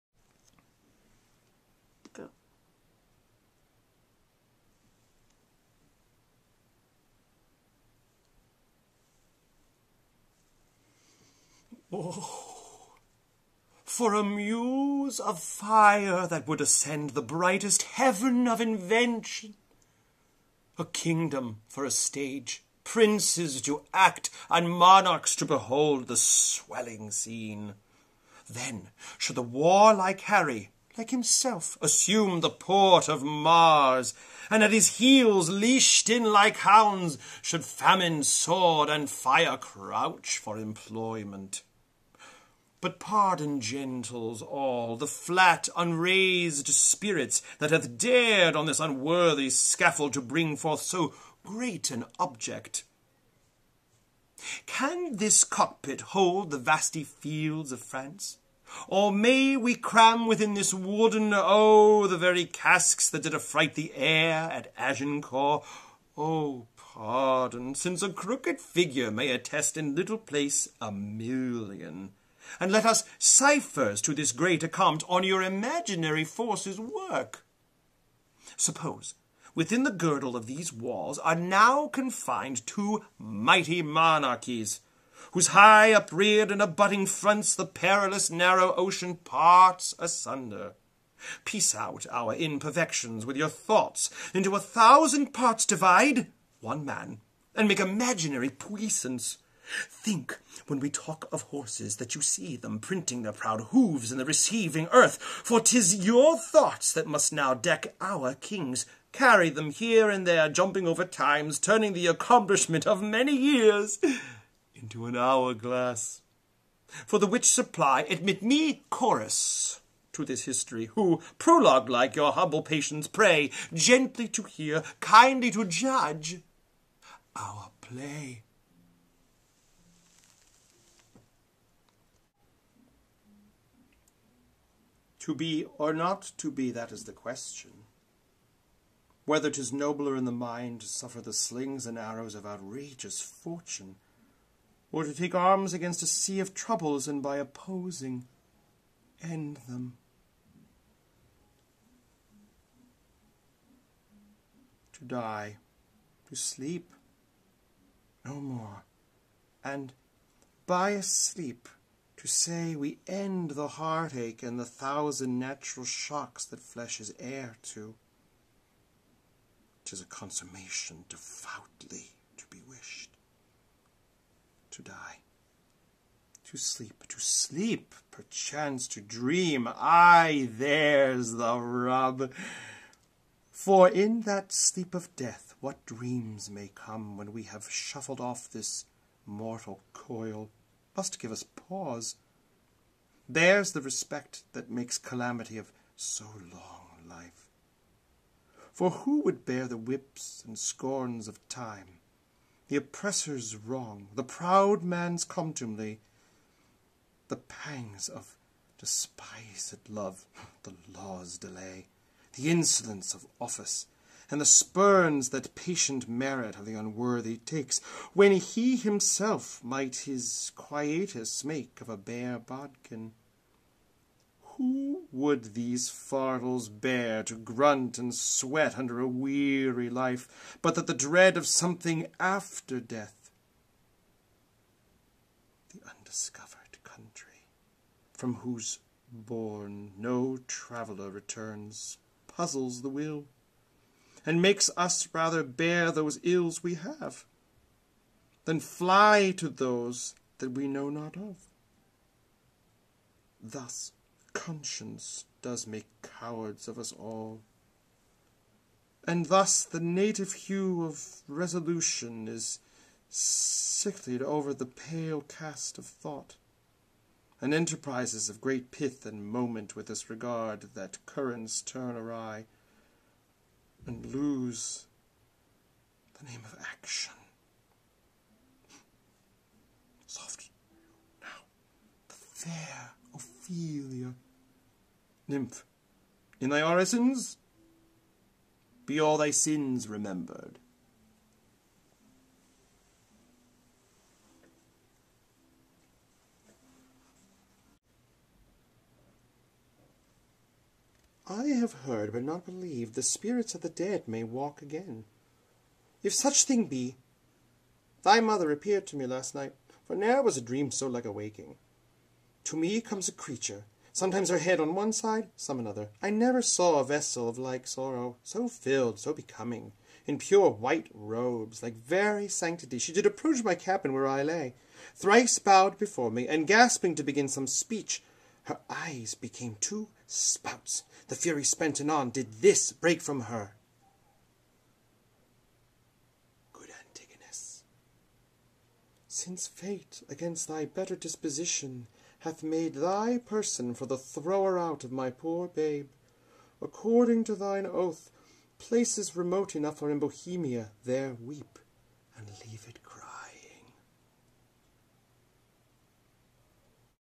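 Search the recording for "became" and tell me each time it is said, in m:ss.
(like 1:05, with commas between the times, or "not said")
5:29.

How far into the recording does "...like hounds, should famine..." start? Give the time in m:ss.
0:36.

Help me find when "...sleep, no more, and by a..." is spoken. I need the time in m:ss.
2:36.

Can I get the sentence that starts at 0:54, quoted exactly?
Can this cockpit hold the vasty fields of France?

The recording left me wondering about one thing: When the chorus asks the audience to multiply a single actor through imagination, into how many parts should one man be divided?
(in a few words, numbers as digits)
1000.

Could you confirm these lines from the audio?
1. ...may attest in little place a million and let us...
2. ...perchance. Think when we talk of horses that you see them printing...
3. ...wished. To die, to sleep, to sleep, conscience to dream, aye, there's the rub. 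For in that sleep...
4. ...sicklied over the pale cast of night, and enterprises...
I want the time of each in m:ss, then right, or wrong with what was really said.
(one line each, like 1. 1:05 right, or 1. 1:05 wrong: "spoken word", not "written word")
1. 1:09 right
2. 1:38 wrong: "puissance", not "perchance"
3. 2:52 wrong: "perchance", not "conscience"
4. 4:23 wrong: "thought", not "night".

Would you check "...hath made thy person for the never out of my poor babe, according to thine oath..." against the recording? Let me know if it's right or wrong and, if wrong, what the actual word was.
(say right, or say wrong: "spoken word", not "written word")
wrong: "thrower", not "never".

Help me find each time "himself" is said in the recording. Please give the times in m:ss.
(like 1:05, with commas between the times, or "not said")
0:31, 3:38.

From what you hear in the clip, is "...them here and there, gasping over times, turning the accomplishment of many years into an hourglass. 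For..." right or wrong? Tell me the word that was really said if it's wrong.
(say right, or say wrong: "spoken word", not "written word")
wrong: "jumping", not "gasping".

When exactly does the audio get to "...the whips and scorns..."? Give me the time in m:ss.
3:19.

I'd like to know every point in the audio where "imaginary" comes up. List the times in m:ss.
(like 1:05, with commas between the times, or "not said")
1:15, 1:37.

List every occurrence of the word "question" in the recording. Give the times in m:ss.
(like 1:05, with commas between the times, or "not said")
2:17.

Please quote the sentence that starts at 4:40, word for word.
Soft now, the fair Ophelia, nymph, in thy orisons be all thy sins remembered.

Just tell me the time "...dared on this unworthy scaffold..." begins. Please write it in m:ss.
0:47.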